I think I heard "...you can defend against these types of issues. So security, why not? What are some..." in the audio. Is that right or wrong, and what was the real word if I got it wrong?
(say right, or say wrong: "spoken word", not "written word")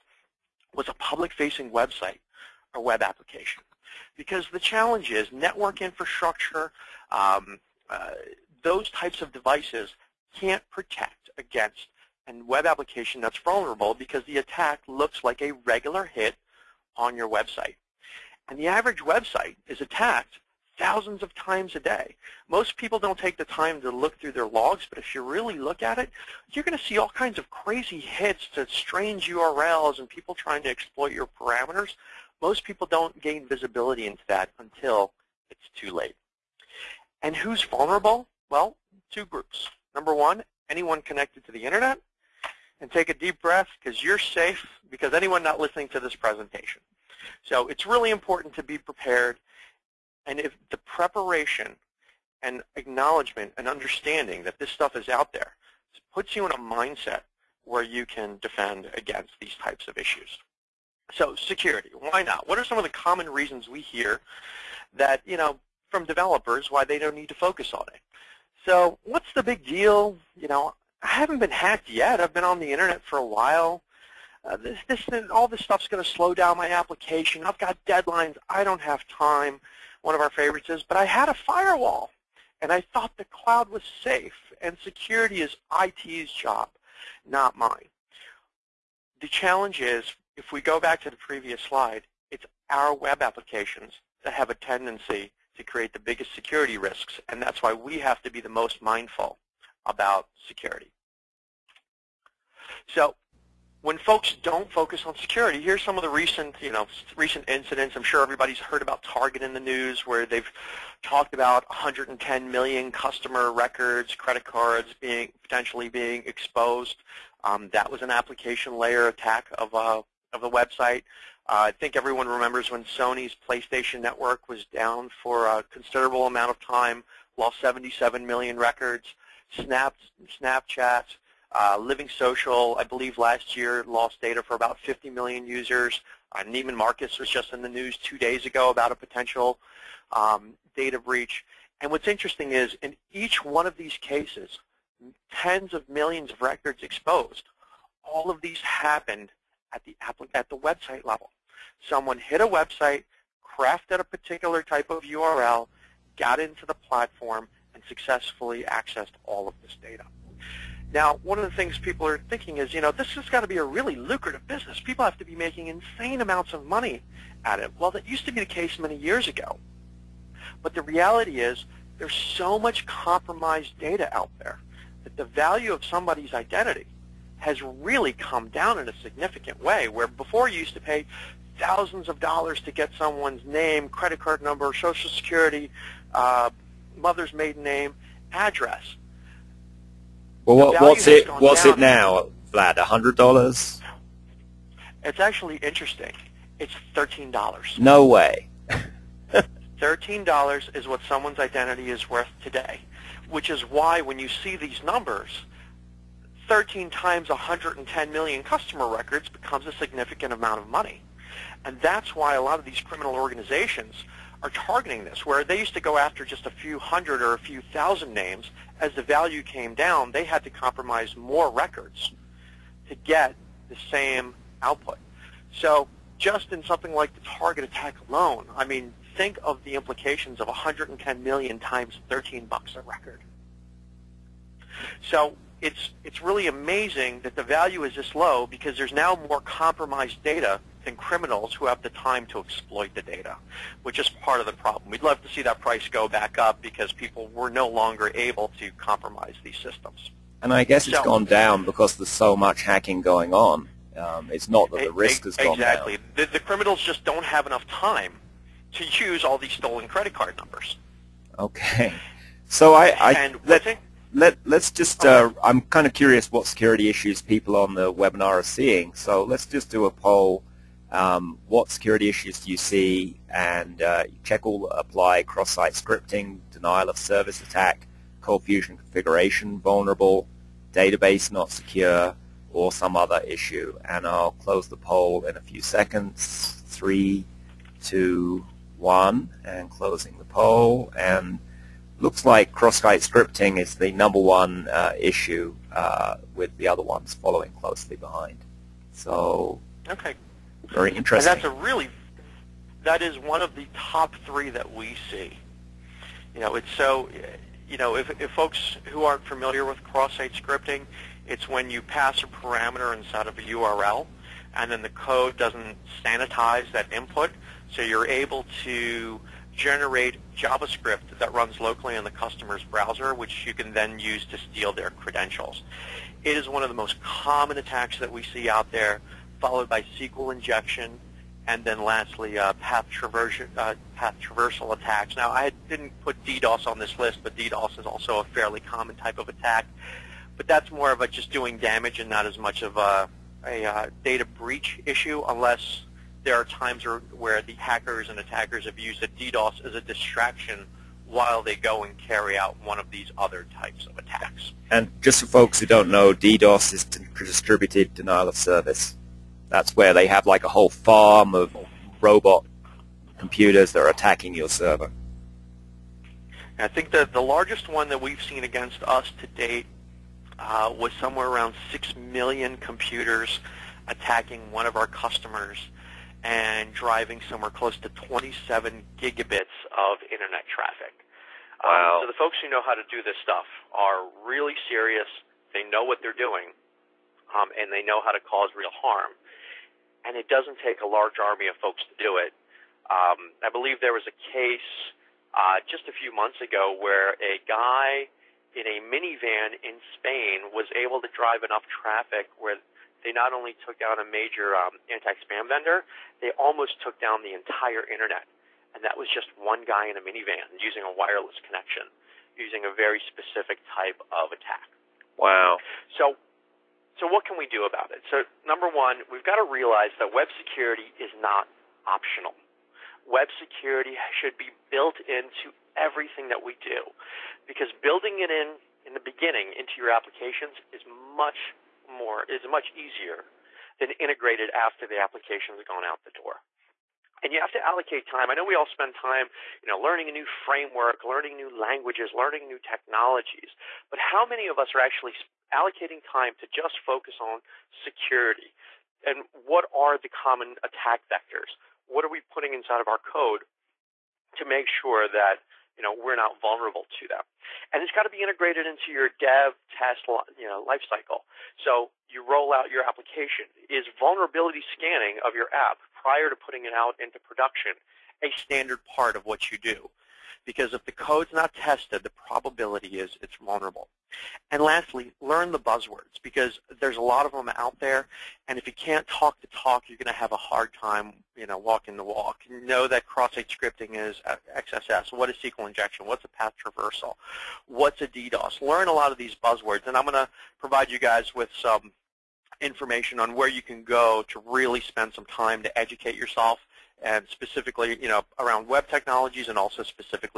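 right.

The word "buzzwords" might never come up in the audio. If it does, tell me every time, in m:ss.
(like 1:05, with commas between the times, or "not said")
7:55, 8:09.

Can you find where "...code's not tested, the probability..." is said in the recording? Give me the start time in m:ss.
7:50.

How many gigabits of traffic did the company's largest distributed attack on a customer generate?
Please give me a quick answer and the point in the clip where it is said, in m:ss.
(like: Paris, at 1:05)
27 gigabits, at 6:17.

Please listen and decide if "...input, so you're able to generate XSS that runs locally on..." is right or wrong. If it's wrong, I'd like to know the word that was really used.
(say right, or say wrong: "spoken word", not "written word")
wrong: "JavaScript", not "XSS".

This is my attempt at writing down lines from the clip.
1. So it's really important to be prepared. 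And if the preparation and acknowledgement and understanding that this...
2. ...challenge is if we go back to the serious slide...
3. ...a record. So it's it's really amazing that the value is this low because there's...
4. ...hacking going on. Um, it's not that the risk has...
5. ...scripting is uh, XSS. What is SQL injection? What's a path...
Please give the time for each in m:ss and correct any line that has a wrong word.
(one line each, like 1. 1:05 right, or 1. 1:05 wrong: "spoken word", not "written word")
1. 0:47 right
2. 1:29 wrong: "previous", not "serious"
3. 3:52 right
4. 4:12 right
5. 8:03 right.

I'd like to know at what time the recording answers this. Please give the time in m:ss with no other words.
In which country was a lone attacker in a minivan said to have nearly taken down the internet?
6:39.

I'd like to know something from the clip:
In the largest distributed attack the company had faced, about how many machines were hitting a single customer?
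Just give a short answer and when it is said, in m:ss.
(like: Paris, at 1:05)
6 million, at 6:11.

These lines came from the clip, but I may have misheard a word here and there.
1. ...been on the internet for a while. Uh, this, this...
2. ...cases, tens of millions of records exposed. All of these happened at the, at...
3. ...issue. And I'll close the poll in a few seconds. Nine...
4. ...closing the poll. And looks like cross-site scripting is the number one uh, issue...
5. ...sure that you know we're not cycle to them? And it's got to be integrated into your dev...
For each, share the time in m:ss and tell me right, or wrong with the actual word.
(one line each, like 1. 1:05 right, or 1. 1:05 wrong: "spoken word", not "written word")
1. 1:12 right
2. 2:23 right
3. 4:43 wrong: "Three", not "Nine"
4. 4:49 right
5. 7:34 wrong: "vulnerable", not "cycle".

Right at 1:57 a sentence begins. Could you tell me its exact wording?
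Um, that was an application layer attack of a uh, of the website.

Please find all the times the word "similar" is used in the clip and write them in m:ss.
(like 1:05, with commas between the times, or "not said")
not said.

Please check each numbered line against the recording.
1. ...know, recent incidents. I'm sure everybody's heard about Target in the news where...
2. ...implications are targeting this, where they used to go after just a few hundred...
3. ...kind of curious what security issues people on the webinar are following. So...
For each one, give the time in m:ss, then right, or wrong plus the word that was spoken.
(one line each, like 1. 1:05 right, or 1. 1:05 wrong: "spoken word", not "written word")
1. 1:46 right
2. 3:33 wrong: "organizations", not "implications"
3. 4:25 wrong: "seeing", not "following".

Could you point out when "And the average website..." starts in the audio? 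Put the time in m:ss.
0:18.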